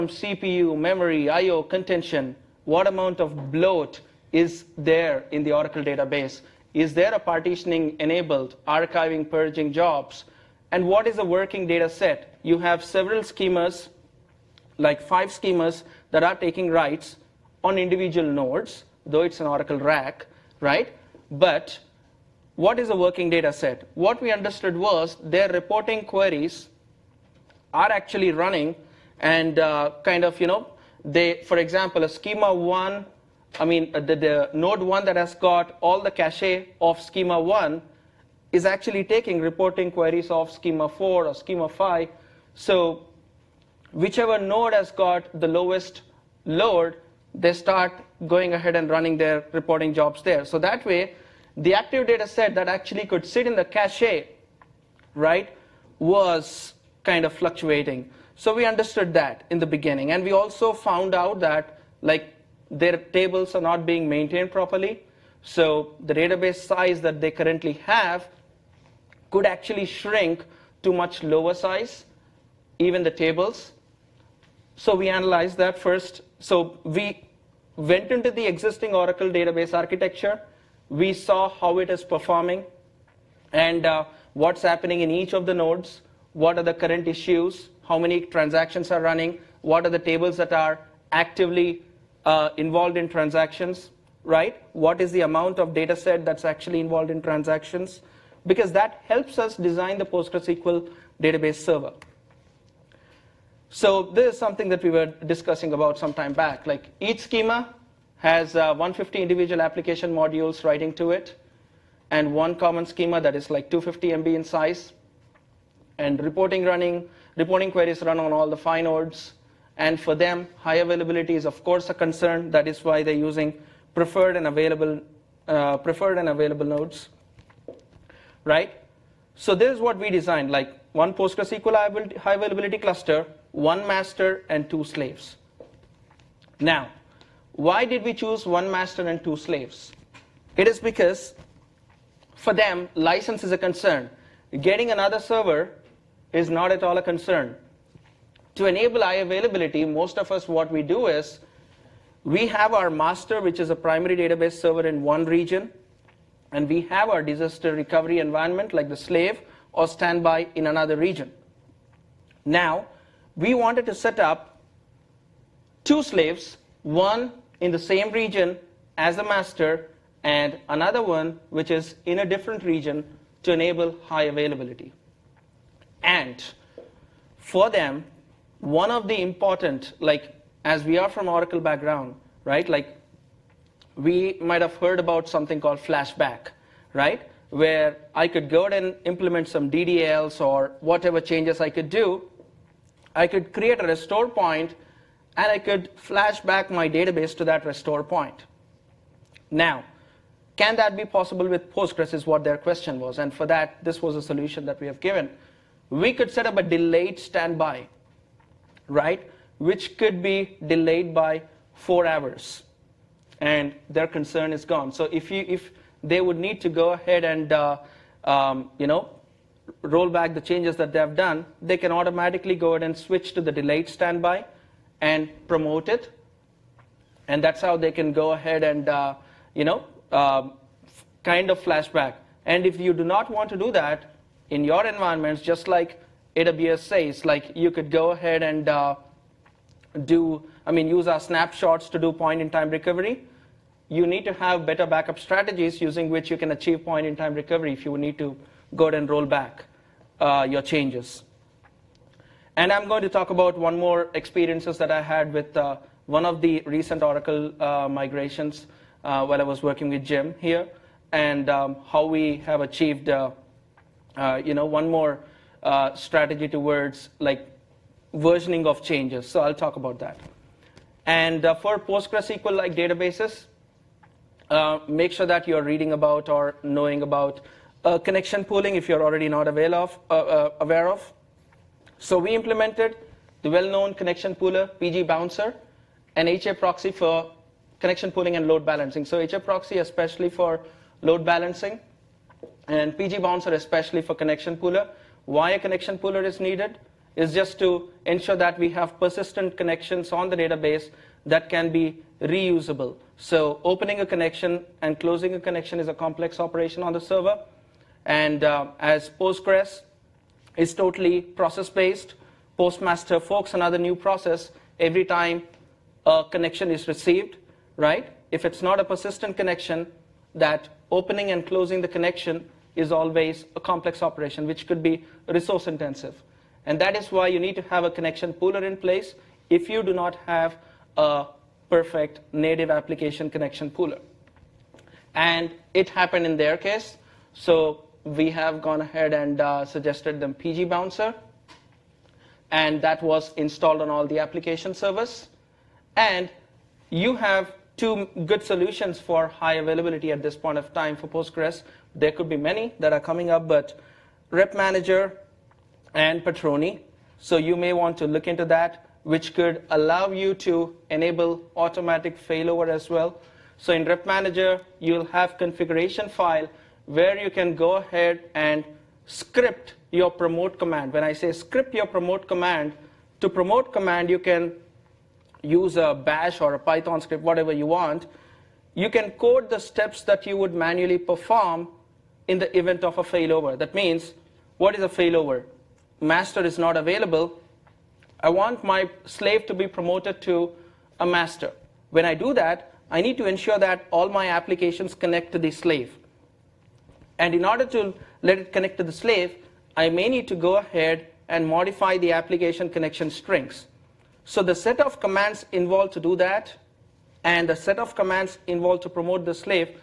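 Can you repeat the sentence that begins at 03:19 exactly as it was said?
Now, can that be possible with Postgres is what their question was.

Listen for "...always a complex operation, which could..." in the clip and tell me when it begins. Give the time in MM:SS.
05:22.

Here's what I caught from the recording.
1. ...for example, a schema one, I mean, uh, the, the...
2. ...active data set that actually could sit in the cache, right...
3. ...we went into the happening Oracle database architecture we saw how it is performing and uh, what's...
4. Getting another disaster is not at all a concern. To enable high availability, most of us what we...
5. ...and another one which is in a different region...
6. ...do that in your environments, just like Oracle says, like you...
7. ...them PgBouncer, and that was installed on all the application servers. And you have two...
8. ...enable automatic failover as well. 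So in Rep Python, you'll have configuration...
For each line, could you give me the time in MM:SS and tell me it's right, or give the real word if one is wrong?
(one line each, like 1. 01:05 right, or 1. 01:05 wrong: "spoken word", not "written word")
1. 00:31 right
2. 00:51 right
3. 01:16 wrong: "existing", not "happening"
4. 02:24 wrong: "server", not "disaster"
5. 02:50 right
6. 03:53 wrong: "AWS", not "Oracle"
7. 05:40 right
8. 06:00 wrong: "Manager", not "Python".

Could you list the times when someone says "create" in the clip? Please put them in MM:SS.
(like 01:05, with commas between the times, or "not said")
03:13.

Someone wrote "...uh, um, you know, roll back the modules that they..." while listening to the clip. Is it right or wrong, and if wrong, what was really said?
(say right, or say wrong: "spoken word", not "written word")
wrong: "changes", not "modules".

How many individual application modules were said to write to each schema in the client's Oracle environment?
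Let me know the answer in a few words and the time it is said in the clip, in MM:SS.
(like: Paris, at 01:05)
150, at 01:48.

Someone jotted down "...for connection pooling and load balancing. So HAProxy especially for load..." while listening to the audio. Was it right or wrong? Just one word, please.
right.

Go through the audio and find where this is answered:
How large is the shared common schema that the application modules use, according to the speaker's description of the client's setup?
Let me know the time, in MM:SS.
01:53.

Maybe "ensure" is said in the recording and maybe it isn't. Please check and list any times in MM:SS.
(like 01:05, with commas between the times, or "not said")
04:58, 06:33.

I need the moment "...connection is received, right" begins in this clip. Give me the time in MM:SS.
05:16.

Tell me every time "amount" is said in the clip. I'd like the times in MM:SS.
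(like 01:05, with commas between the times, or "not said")
00:02, 01:35.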